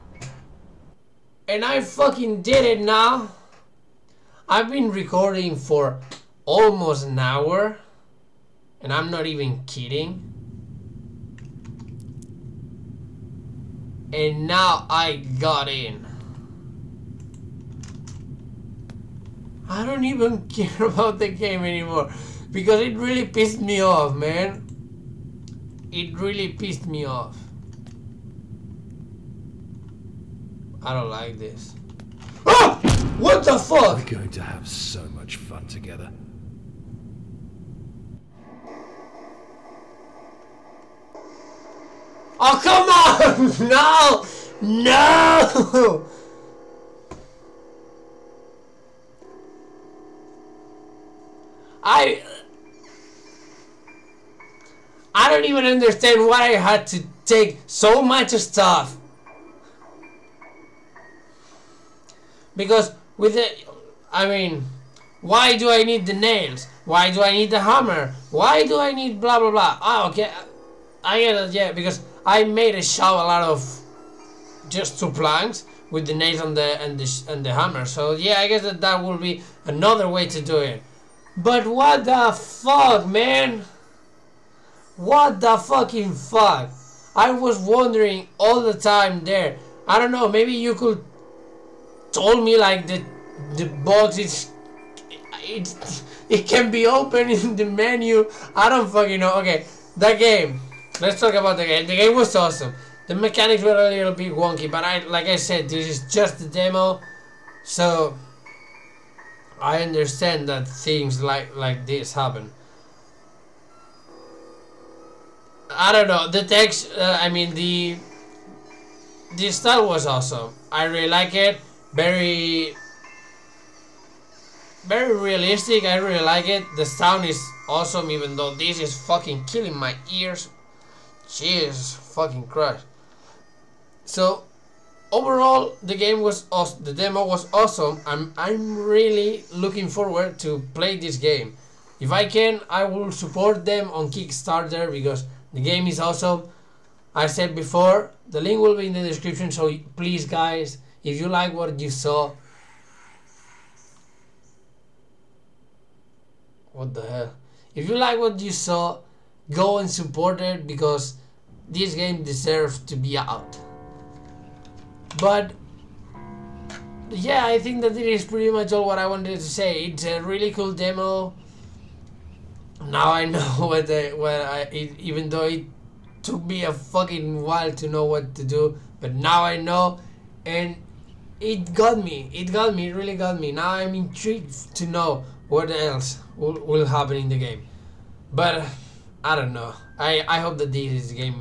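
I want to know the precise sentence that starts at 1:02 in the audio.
Because with it, I mean, why do I need the nails?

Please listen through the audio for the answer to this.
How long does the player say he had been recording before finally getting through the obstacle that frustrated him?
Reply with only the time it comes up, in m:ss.
0:06.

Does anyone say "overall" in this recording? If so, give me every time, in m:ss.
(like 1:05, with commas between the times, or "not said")
2:15.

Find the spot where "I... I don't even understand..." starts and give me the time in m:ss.
0:51.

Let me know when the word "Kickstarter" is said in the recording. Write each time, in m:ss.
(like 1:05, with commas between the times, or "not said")
2:24.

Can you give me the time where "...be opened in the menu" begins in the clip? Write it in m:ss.
1:36.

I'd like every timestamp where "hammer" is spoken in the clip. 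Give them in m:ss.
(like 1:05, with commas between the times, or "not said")
1:07, 1:17.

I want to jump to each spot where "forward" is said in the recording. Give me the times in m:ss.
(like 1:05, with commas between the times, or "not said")
2:19.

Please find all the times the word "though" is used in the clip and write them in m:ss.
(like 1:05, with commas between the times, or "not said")
2:08, 2:55.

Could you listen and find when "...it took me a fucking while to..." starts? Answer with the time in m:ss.
2:55.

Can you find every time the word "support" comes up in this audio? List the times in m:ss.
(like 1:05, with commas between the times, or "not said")
2:23, 2:39.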